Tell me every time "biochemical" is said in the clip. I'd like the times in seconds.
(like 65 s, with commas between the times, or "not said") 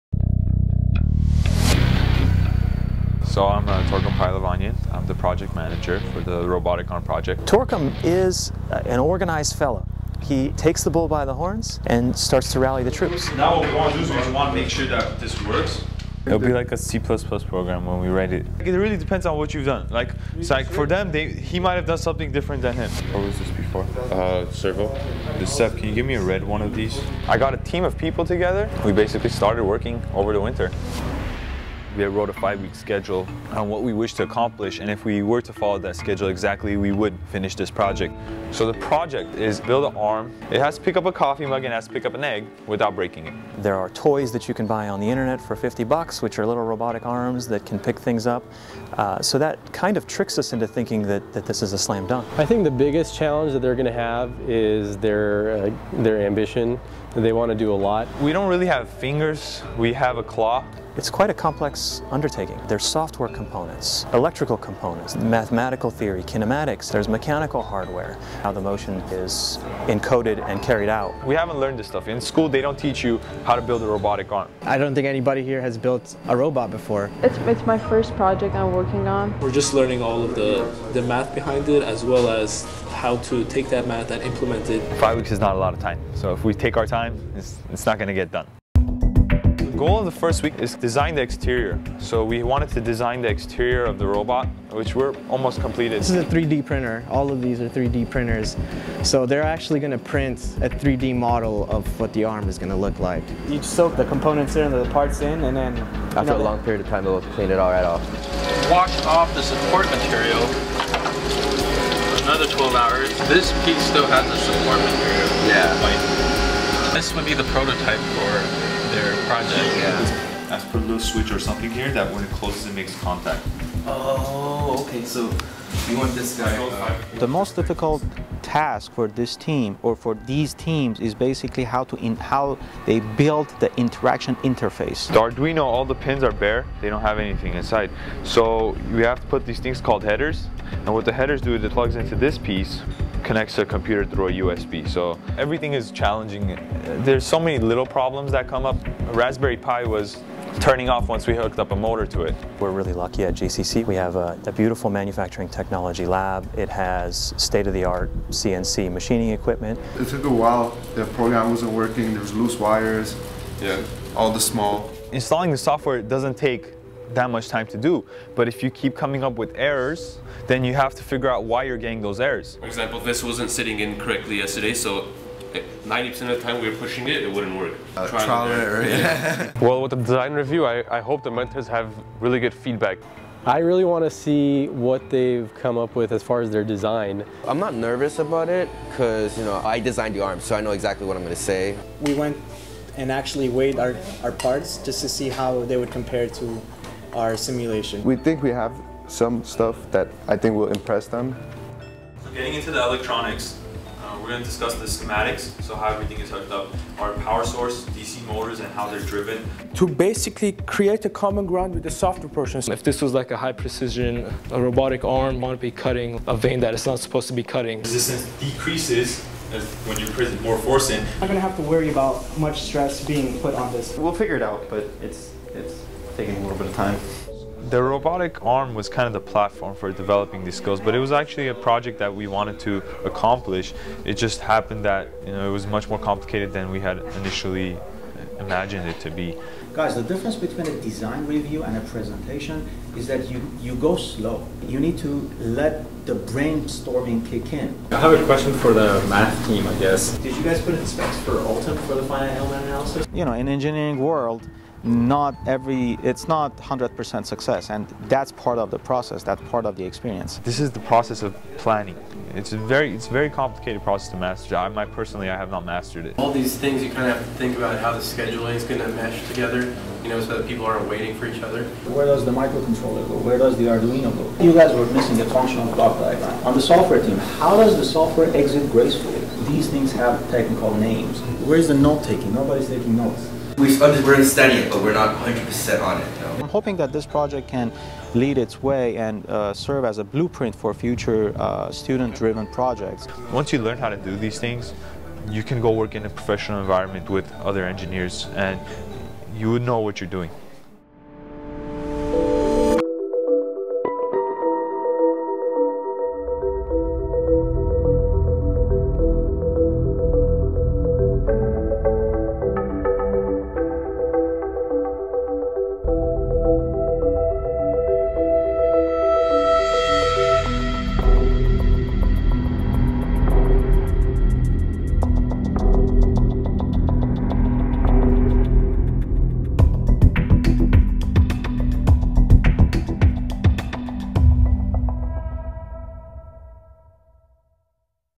not said.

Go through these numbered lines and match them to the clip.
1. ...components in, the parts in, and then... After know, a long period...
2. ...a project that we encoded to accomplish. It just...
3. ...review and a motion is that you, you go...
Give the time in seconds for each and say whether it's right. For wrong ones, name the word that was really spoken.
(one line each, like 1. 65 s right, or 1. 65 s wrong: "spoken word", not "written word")
1. 104 s right
2. 231 s wrong: "wanted", not "encoded"
3. 241 s wrong: "presentation", not "motion".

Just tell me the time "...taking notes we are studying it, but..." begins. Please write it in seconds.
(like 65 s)
282 s.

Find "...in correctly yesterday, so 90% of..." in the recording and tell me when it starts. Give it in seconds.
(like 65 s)
173 s.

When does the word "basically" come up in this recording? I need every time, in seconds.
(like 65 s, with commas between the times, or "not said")
28 s, 131 s, 209 s.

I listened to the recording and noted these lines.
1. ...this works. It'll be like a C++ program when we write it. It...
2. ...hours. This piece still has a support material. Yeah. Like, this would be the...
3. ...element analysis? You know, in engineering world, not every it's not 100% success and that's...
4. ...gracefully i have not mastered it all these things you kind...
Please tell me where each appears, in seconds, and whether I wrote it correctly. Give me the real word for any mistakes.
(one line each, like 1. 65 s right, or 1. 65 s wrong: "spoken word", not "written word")
1. 15 s right
2. 112 s right
3. 252 s right
4. 264 s wrong: "personally", not "gracefully".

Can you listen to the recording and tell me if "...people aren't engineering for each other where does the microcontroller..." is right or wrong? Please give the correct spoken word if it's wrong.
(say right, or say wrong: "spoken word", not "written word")
wrong: "waiting", not "engineering".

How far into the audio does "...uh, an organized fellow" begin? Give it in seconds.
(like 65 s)
8 s.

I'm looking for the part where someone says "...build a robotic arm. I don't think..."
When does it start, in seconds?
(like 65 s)
73 s.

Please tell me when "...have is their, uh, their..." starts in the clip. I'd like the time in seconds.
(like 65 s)
53 s.